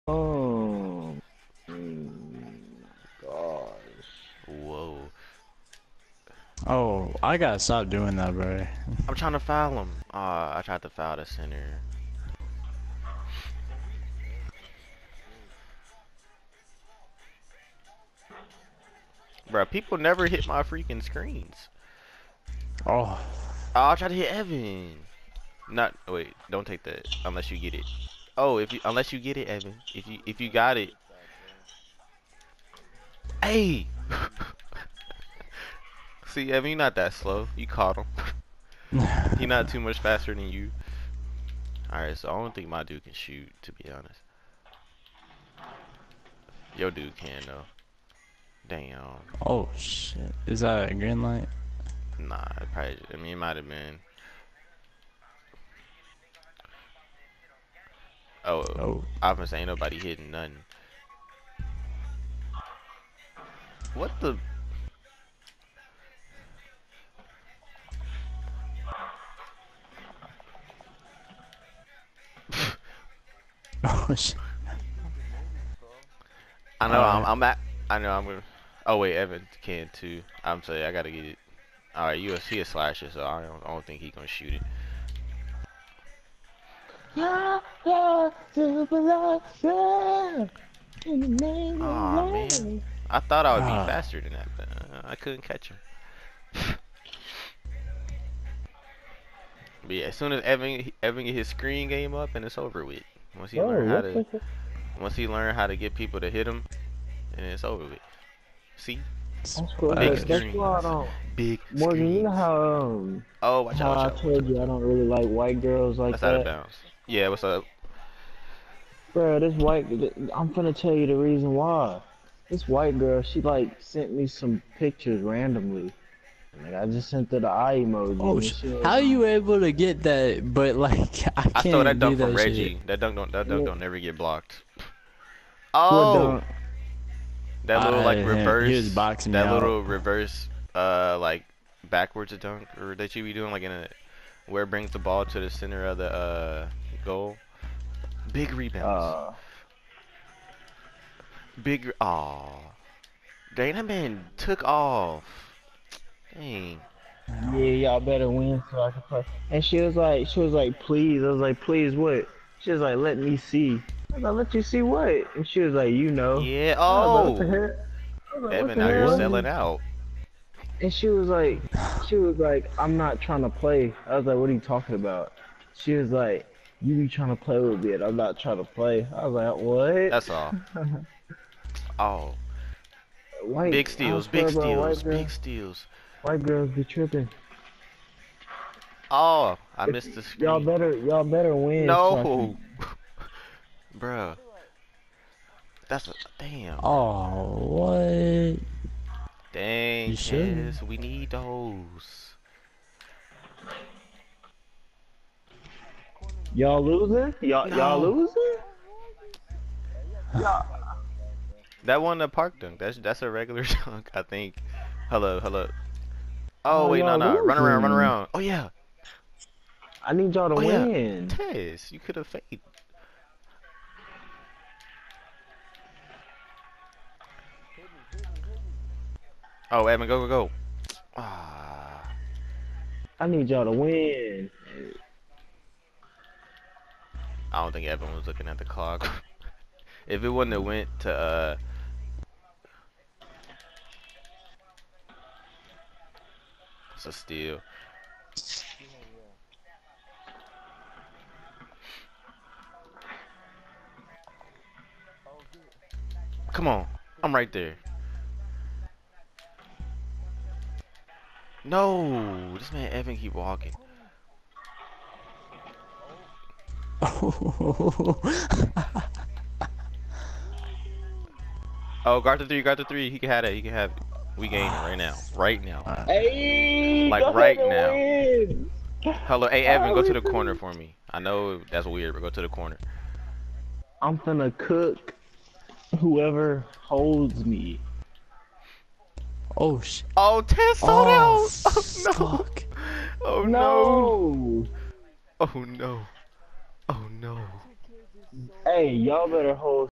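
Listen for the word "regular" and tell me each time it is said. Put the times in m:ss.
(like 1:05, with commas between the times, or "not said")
3:33.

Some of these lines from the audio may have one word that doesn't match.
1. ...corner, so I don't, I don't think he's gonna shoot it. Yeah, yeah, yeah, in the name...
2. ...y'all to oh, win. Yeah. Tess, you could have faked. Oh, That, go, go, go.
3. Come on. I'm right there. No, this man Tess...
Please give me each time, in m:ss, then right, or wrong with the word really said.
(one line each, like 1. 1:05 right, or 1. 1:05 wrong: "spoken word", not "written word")
1. 1:22 wrong: "slasher", not "corner"
2. 3:40 wrong: "Evan", not "That"
3. 4:16 wrong: "Evan", not "Tess".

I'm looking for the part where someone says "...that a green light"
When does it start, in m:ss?
0:50.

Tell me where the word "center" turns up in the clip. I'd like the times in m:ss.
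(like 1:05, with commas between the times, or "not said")
0:11, 2:25.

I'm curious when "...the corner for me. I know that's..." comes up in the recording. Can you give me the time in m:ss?
4:40.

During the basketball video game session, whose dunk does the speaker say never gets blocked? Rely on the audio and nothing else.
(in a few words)
Reggie.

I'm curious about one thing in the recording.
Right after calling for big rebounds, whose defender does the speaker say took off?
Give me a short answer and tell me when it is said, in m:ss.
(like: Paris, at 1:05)
Dana, at 2:33.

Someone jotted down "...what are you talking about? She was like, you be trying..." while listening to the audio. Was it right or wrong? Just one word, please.
right.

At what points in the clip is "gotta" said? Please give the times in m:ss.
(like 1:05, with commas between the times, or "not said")
0:07, 1:20.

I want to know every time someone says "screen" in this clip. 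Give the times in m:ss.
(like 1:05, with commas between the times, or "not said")
0:21, 1:41, 3:10.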